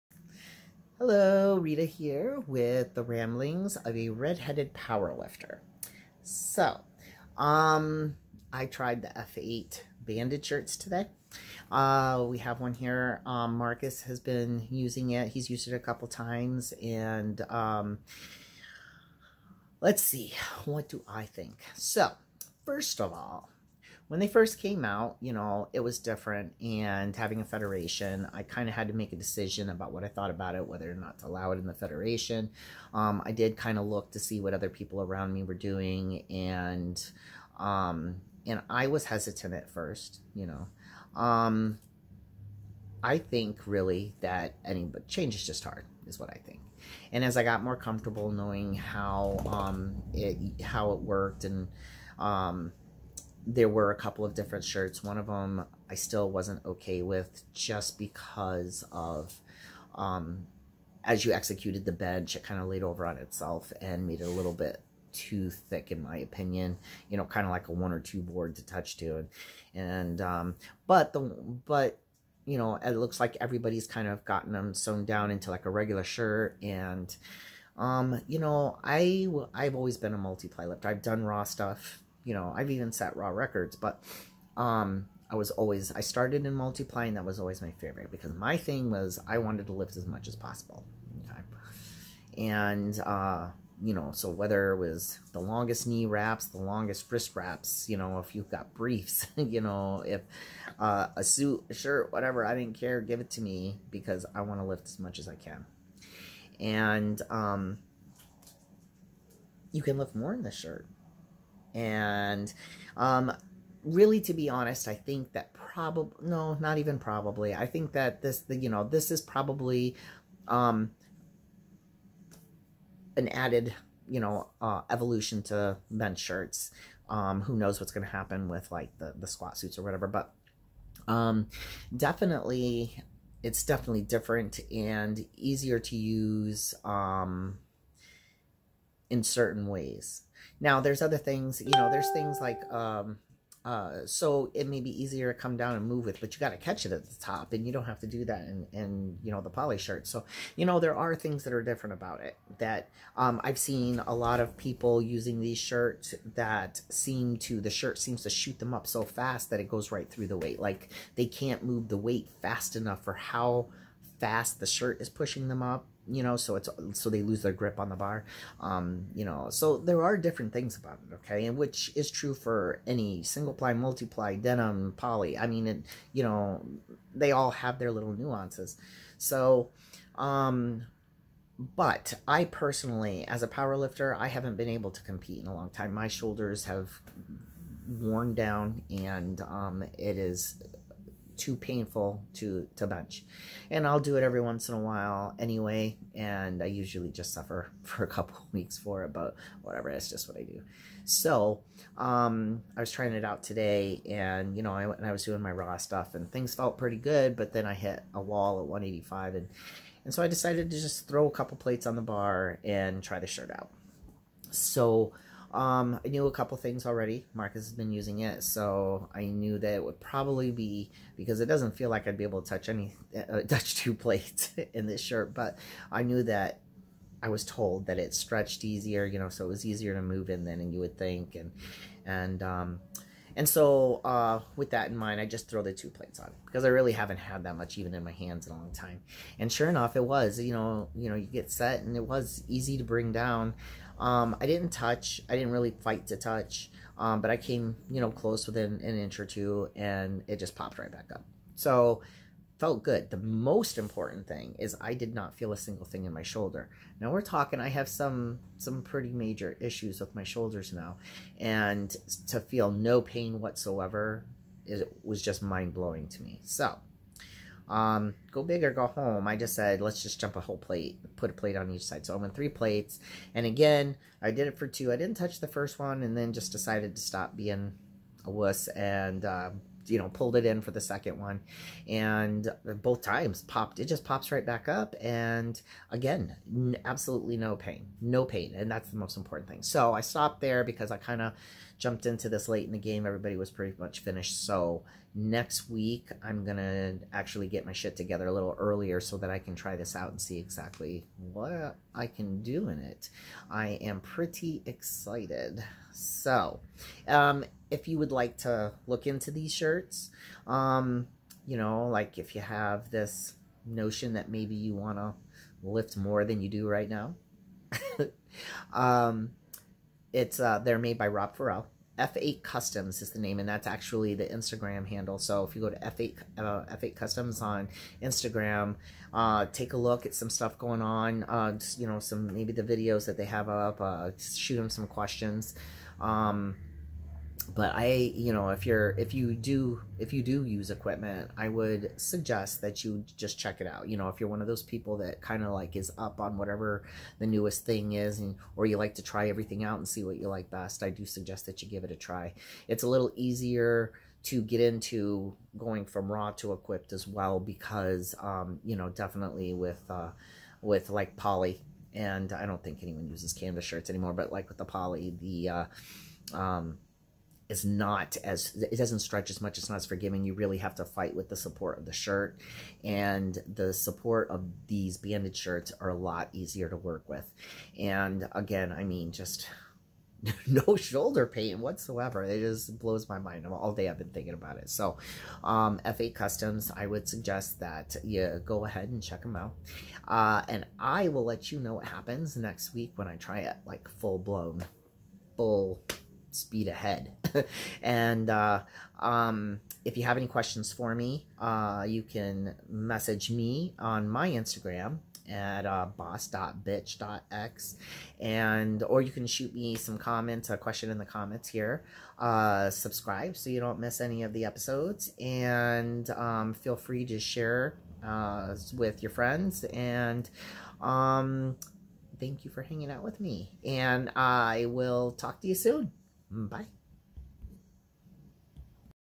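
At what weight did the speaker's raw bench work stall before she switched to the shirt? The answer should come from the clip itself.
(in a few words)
185.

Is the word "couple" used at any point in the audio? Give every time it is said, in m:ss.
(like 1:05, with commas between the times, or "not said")
0:15, 0:53, 3:18, 3:31, 3:36.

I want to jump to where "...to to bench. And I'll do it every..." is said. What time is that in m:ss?
3:12.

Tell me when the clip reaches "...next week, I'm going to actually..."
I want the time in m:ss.
4:55.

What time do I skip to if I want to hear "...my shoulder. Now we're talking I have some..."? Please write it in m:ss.
4:16.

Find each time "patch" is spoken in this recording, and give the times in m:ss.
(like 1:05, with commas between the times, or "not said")
not said.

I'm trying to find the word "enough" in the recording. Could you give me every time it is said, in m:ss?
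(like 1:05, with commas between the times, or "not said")
2:42, 3:59.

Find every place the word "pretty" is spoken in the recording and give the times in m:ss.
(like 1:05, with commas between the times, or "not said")
3:26, 4:18, 4:53, 5:03.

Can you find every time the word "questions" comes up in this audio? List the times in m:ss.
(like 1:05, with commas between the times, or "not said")
5:34, 6:40, 6:50.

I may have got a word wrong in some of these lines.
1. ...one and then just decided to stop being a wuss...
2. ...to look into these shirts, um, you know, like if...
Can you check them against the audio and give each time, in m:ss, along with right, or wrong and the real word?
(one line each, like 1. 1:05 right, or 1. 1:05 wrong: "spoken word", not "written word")
1. 4:35 right
2. 5:08 right.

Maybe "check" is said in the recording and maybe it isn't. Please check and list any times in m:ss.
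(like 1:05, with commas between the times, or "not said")
5:43, 6:29.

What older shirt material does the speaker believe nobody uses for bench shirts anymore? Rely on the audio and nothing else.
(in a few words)
Canvas.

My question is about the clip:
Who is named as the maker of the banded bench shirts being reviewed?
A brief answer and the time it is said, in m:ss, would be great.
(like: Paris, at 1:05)
Rob Farrell, at 5:21.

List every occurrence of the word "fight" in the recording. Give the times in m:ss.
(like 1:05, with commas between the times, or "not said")
4:05, 6:10.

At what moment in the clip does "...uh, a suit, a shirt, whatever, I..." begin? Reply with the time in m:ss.
1:40.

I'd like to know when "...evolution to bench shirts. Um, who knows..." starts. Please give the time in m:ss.
2:04.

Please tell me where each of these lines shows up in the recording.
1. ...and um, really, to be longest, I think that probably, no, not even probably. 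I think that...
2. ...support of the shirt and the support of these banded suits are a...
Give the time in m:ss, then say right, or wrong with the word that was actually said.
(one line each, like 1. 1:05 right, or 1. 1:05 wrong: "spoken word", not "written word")
1. 1:51 wrong: "honest", not "longest"
2. 6:11 wrong: "shirts", not "suits".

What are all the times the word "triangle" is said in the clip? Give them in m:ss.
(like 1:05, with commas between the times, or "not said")
not said.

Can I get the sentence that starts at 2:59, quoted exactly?
So, um, but I personally, as a power lifter, I haven't been able to compete in a long time.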